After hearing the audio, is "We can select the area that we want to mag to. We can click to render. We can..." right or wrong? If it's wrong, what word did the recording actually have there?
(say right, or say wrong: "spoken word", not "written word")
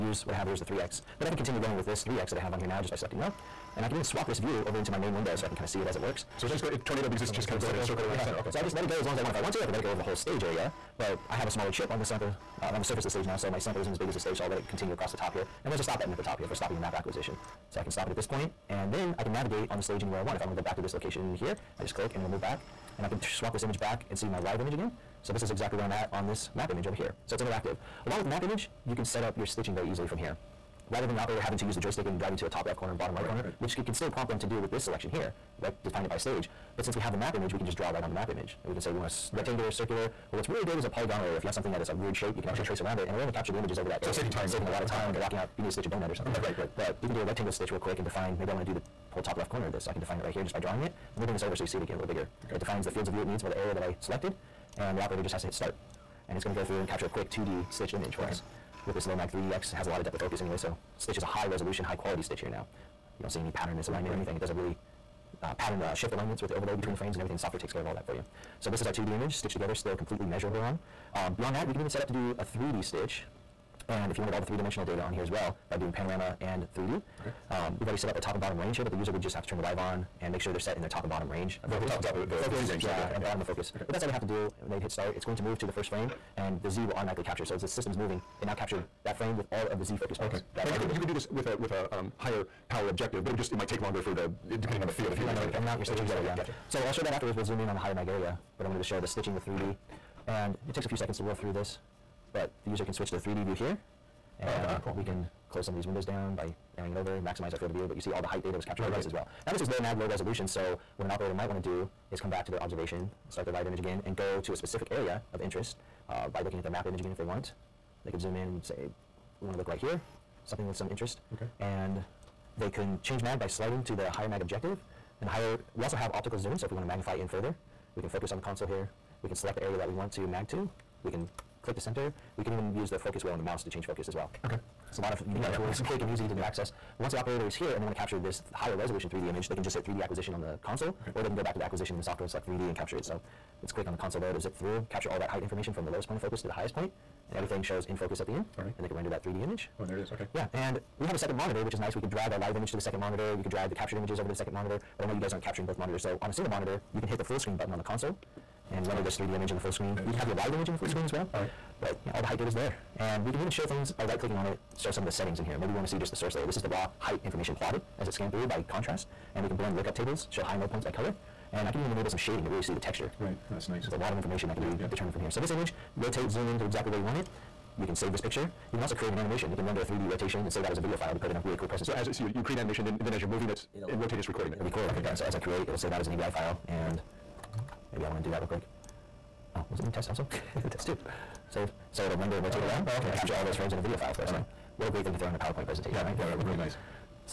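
wrong: "center", not "render".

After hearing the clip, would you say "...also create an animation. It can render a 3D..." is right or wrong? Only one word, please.
right.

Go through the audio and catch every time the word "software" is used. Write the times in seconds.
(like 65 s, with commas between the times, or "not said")
67 s, 142 s.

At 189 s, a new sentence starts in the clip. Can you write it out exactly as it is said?
Oh, was it named test also?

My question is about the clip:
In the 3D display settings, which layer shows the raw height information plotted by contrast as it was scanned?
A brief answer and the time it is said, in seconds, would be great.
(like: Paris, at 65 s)
Source layer, at 166 s.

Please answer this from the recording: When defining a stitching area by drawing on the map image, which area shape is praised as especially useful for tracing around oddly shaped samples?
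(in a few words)
Polygonal.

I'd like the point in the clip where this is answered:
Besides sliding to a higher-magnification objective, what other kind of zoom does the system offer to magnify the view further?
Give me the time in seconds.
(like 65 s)
126 s.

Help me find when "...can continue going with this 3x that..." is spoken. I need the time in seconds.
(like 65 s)
1 s.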